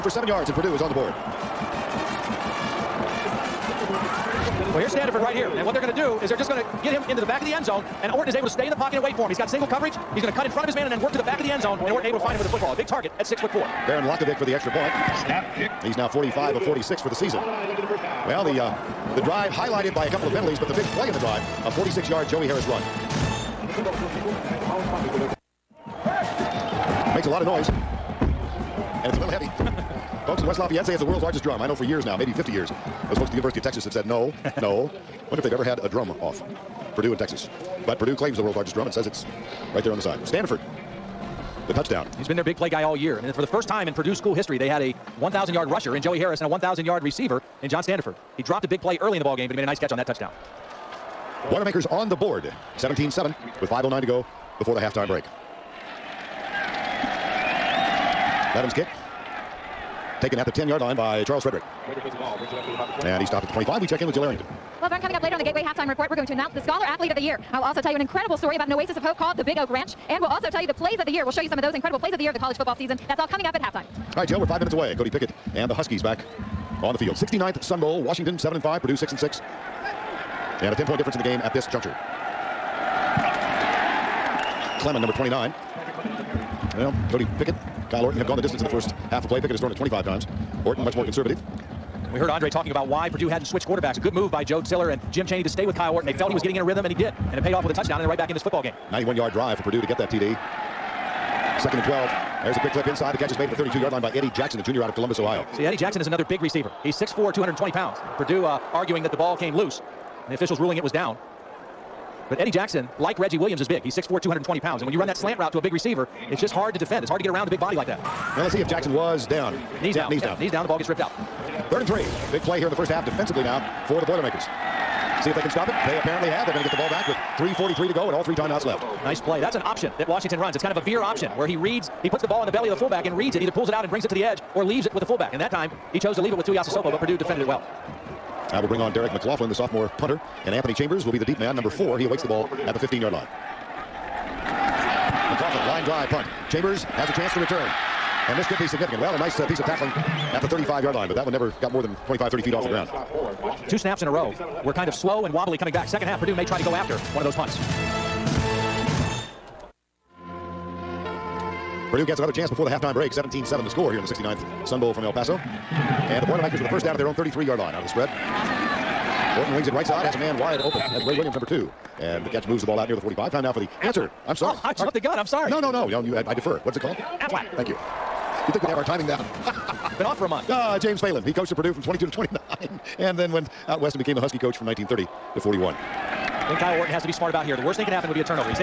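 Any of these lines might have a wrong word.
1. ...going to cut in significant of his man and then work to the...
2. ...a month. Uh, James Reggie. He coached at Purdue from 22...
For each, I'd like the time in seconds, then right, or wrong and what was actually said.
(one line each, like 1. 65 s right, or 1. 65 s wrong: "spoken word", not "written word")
1. 10 s wrong: "front", not "significant"
2. 180 s wrong: "Phelan", not "Reggie".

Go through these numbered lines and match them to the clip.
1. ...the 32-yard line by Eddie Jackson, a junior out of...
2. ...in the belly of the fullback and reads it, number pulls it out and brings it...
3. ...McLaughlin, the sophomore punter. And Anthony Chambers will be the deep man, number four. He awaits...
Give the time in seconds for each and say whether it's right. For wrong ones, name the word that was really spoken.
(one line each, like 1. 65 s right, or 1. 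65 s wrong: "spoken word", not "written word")
1. 103 s right
2. 132 s wrong: "either", not "number"
3. 139 s right.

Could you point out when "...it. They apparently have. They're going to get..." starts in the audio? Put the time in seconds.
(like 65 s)
125 s.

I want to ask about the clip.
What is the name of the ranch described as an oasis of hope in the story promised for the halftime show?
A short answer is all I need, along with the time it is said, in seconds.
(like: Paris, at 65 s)
Big Oak Ranch, at 69 s.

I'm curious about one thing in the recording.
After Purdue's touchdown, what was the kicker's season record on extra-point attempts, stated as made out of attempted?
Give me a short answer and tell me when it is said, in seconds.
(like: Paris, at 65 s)
45 of 46, at 16 s.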